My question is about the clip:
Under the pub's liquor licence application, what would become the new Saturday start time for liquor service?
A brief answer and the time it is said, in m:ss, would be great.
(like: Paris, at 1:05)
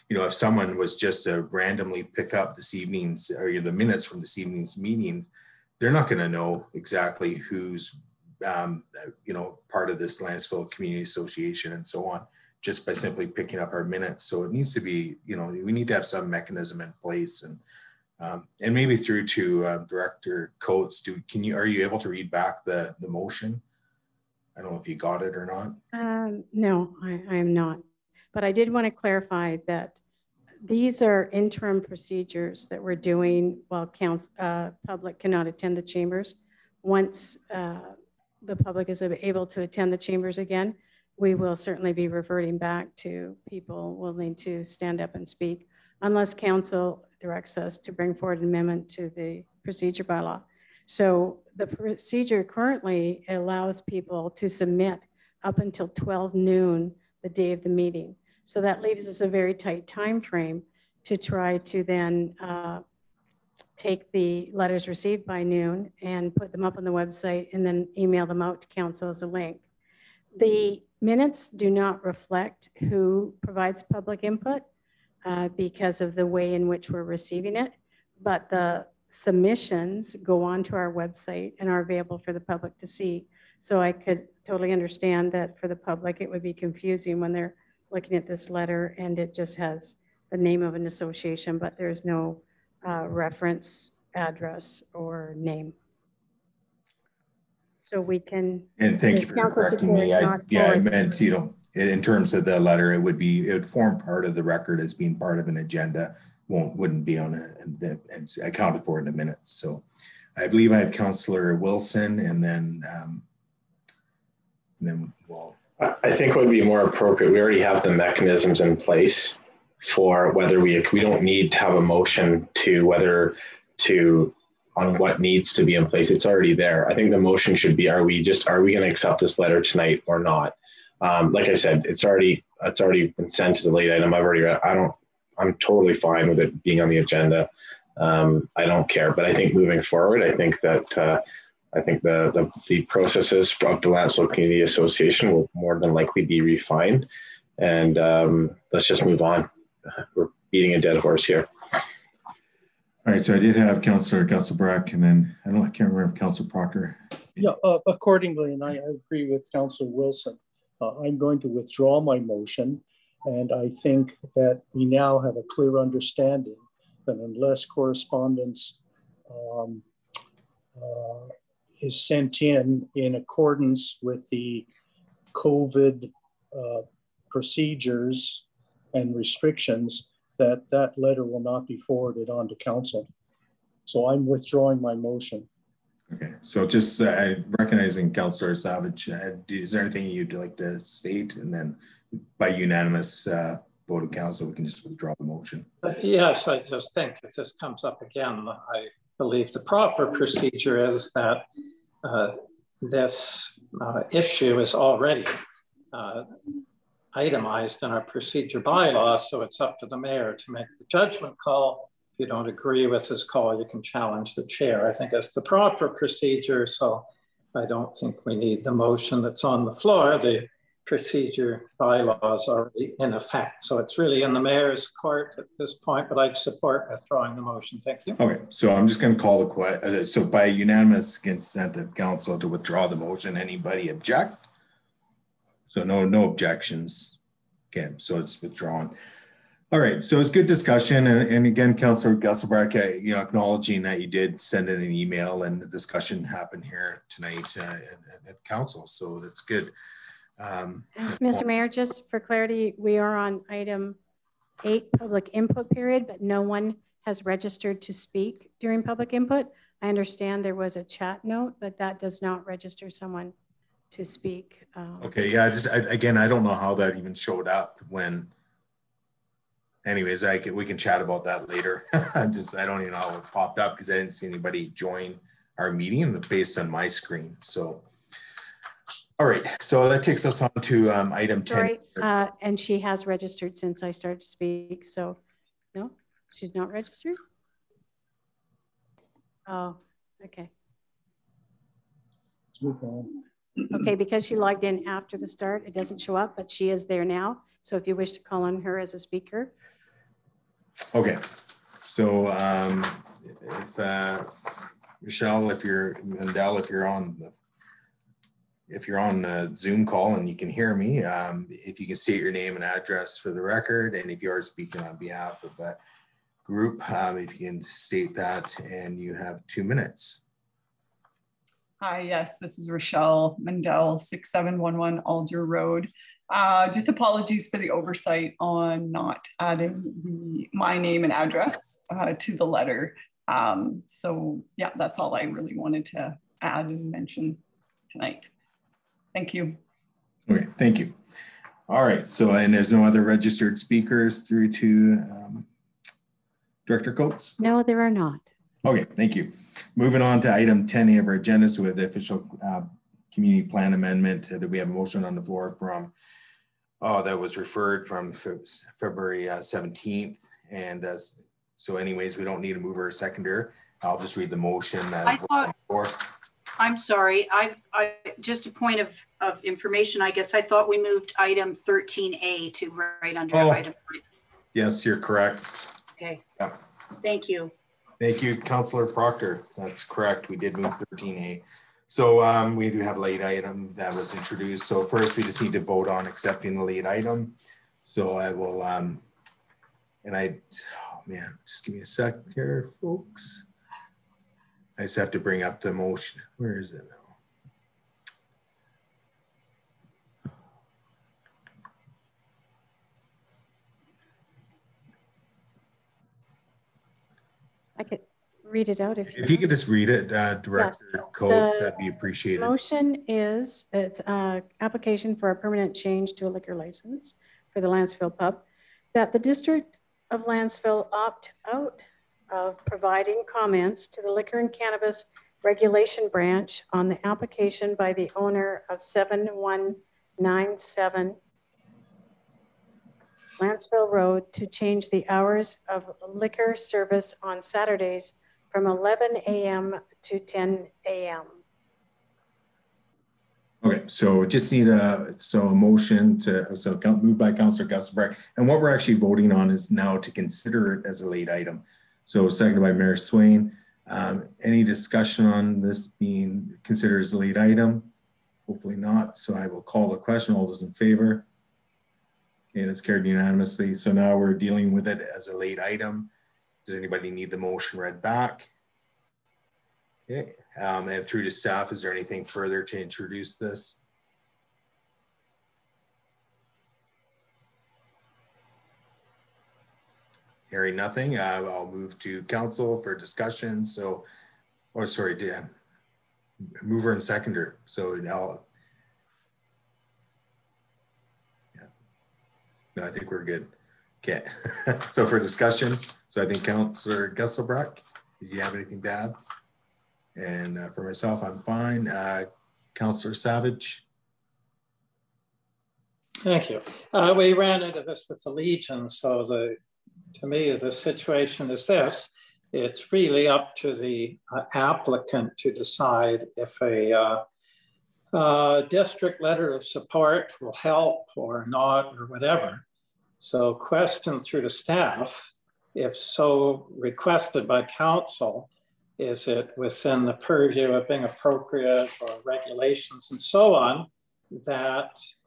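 10 a.m., at 7:20.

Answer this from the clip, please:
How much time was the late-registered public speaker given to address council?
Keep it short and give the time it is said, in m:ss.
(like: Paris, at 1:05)
2 minutes, at 5:19.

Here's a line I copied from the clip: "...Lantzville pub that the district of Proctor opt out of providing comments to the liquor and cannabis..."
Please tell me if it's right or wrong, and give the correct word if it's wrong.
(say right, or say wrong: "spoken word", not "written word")
wrong: "Lantzville", not "Proctor".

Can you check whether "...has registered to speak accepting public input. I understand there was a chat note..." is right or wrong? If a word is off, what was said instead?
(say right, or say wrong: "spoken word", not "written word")
wrong: "during", not "accepting".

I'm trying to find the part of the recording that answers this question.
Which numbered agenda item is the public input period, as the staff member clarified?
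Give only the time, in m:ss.
4:13.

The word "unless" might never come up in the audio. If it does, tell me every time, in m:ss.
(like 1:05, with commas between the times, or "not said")
0:46, 2:47.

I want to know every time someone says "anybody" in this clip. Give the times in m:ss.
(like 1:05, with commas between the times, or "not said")
3:53, 4:34, 7:46.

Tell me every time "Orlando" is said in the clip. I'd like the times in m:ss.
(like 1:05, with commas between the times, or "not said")
not said.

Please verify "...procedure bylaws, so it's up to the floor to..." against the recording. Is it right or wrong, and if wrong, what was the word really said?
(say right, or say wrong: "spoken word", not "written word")
wrong: "mayor", not "floor".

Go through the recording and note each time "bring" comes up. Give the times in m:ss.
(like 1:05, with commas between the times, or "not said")
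0:47, 6:35.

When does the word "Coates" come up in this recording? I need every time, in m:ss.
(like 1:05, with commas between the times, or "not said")
0:20, 5:46.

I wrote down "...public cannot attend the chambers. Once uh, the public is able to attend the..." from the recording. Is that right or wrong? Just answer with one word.
right.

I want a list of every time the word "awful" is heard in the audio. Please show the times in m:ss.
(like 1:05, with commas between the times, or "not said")
not said.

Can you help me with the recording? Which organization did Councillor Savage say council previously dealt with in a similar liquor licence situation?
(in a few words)
The Legion.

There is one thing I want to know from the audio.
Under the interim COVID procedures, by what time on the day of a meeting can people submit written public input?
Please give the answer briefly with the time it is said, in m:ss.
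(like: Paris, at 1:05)
12 noon, at 0:55.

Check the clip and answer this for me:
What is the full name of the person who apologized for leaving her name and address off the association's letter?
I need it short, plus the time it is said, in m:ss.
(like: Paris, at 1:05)
Rochelle Mandel, at 5:22.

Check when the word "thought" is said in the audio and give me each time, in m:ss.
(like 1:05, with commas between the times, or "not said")
6:05, 6:10.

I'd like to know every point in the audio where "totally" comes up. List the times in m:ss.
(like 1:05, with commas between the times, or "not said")
1:24, 2:15.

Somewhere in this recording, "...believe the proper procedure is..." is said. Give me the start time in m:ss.
3:19.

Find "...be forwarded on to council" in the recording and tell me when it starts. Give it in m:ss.
3:01.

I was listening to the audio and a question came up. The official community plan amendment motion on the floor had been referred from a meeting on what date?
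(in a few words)
February 17.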